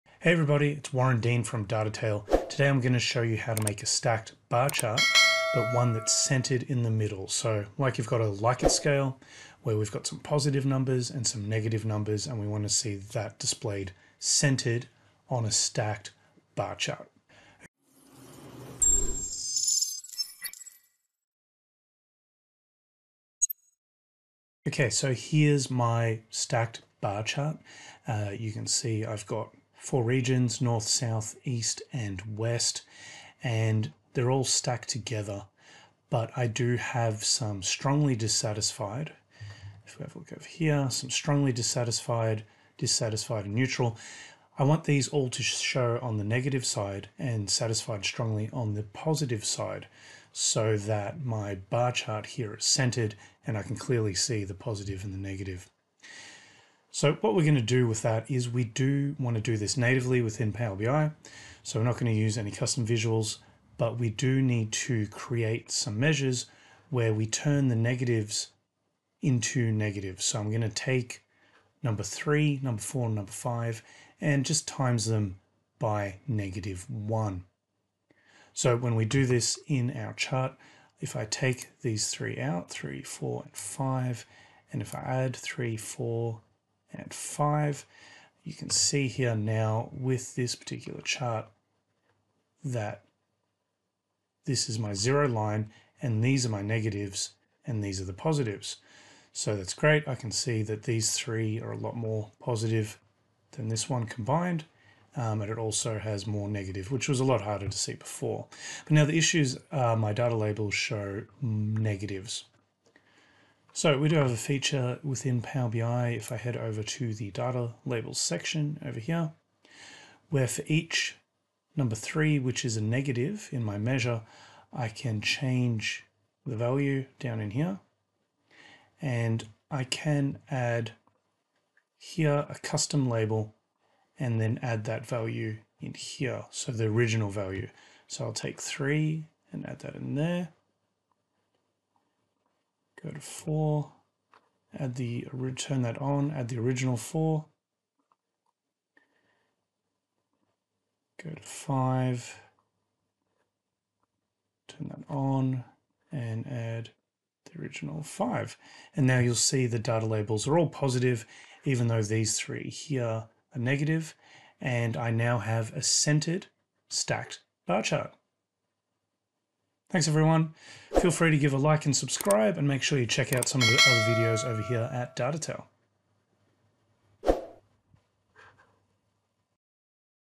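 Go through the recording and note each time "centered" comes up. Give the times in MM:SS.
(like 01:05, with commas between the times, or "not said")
00:06, 00:14, 00:52, 02:45.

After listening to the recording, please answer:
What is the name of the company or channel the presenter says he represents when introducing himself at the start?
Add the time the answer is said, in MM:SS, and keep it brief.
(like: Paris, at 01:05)
Tale, at 00:01.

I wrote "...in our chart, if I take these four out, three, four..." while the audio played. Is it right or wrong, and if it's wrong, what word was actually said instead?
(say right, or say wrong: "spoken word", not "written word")
wrong: "three", not "four".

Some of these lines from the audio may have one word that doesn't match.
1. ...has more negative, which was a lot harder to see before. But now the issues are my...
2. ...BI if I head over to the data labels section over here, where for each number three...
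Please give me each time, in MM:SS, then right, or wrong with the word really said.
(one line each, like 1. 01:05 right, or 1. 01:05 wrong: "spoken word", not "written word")
1. 01:45 right
2. 01:55 right.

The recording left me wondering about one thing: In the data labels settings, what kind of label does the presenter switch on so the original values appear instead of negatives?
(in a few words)
custom label.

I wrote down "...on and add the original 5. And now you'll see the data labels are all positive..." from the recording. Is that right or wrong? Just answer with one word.
right.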